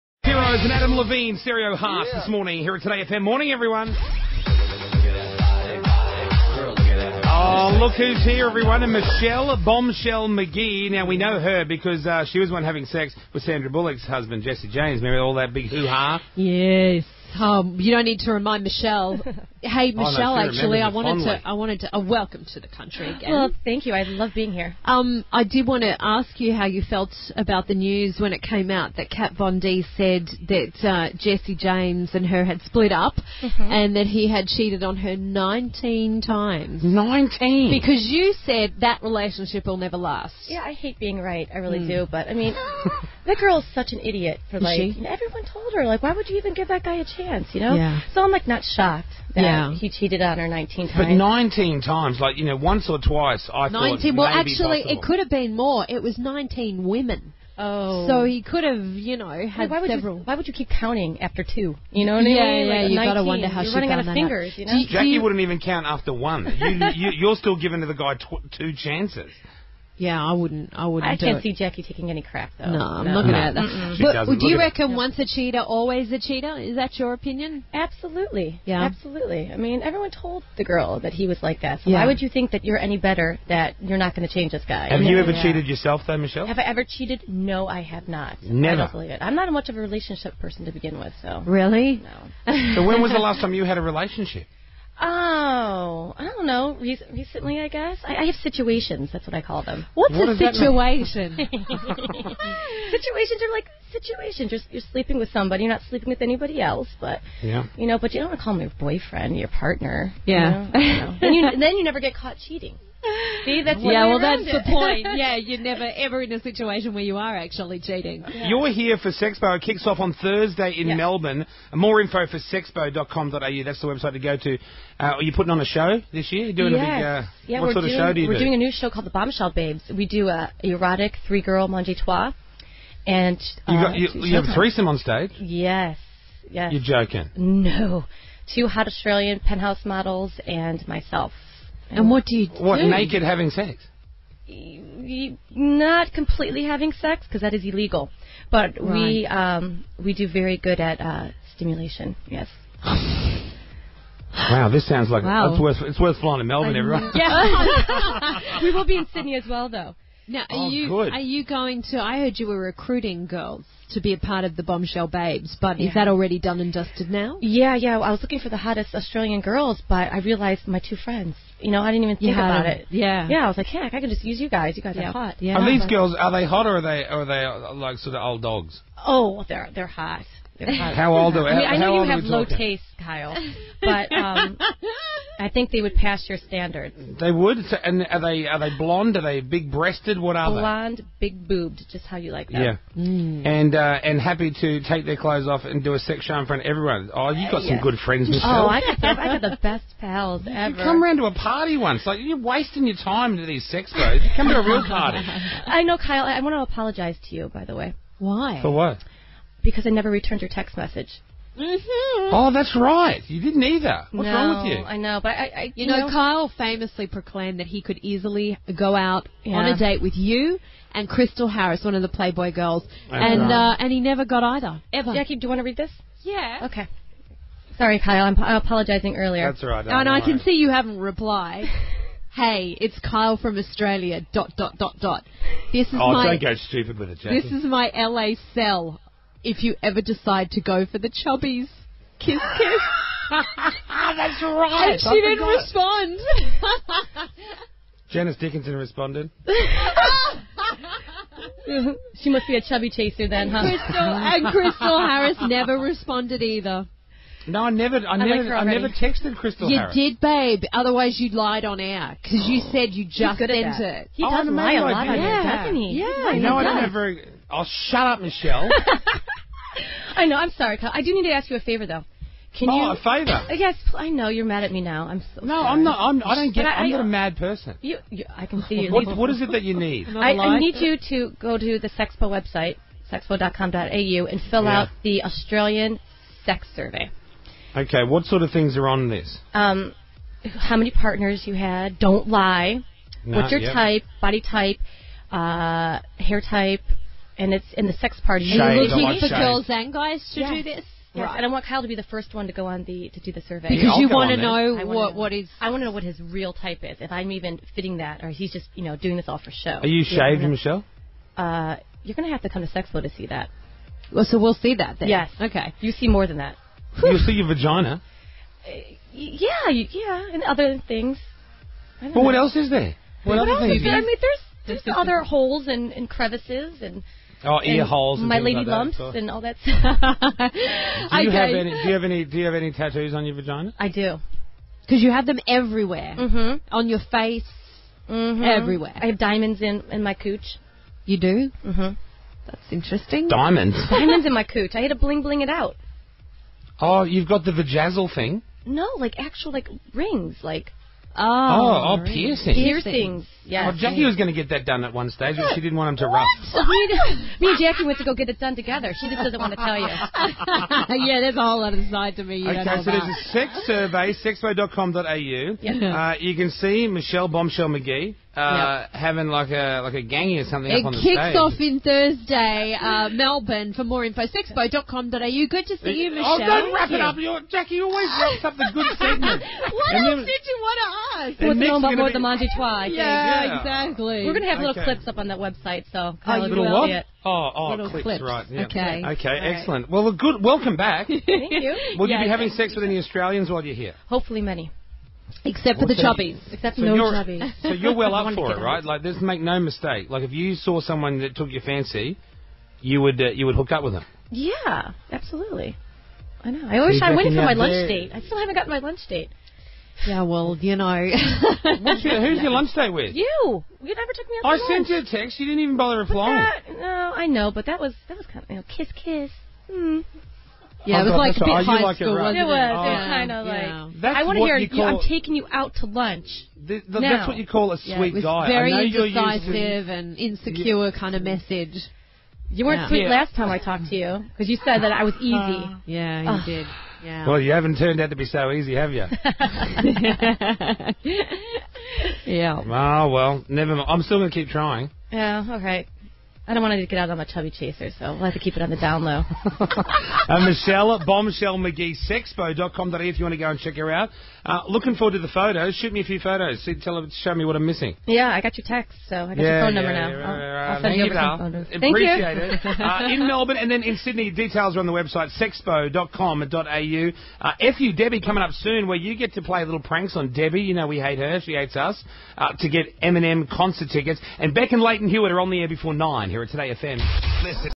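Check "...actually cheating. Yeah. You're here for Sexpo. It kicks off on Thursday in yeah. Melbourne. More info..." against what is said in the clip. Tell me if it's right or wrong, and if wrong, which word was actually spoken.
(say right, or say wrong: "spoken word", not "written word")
right.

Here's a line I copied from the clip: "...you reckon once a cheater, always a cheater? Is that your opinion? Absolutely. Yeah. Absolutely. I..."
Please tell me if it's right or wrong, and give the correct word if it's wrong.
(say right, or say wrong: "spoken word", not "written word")
right.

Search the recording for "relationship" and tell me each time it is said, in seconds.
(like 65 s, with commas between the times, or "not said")
39 s, 89 s, 93 s.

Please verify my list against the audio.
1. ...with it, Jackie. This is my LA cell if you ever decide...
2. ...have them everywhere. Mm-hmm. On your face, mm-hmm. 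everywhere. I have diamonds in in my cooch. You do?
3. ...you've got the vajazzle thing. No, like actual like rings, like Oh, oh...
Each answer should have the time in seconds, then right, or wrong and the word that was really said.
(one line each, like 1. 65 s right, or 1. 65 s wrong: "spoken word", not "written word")
1. 236 s right
2. 335 s right
3. 347 s right.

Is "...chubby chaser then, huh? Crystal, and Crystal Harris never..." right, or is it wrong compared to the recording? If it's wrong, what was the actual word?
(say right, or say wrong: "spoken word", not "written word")
right.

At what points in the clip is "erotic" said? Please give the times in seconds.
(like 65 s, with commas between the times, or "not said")
130 s.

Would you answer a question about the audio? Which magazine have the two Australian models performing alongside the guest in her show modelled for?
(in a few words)
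Penthouse.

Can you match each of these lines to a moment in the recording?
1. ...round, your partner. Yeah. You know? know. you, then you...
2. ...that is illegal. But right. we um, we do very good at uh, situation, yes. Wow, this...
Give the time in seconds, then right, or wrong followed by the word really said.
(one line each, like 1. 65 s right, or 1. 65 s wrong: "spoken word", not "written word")
1. 108 s wrong: "boyfriend", not "round"
2. 147 s wrong: "stimulation", not "situation".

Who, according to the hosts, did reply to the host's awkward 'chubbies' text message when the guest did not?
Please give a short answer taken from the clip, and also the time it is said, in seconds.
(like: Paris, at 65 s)
Janice Dickinson, at 248 s.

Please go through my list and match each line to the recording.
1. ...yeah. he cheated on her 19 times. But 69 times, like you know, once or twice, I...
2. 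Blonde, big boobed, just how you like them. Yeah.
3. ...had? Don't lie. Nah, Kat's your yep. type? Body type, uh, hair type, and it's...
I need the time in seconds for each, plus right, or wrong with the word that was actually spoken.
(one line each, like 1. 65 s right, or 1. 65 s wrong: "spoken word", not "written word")
1. 49 s wrong: "19", not "69"
2. 191 s right
3. 291 s wrong: "What", not "Kat".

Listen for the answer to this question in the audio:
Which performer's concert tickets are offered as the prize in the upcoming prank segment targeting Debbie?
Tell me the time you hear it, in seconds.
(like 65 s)
473 s.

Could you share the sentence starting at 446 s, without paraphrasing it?
I don't want to get out on my chubby chaser, so we'll have to keep it on the down low.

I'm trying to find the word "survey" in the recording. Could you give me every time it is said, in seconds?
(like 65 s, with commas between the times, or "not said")
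286 s, 303 s, 363 s.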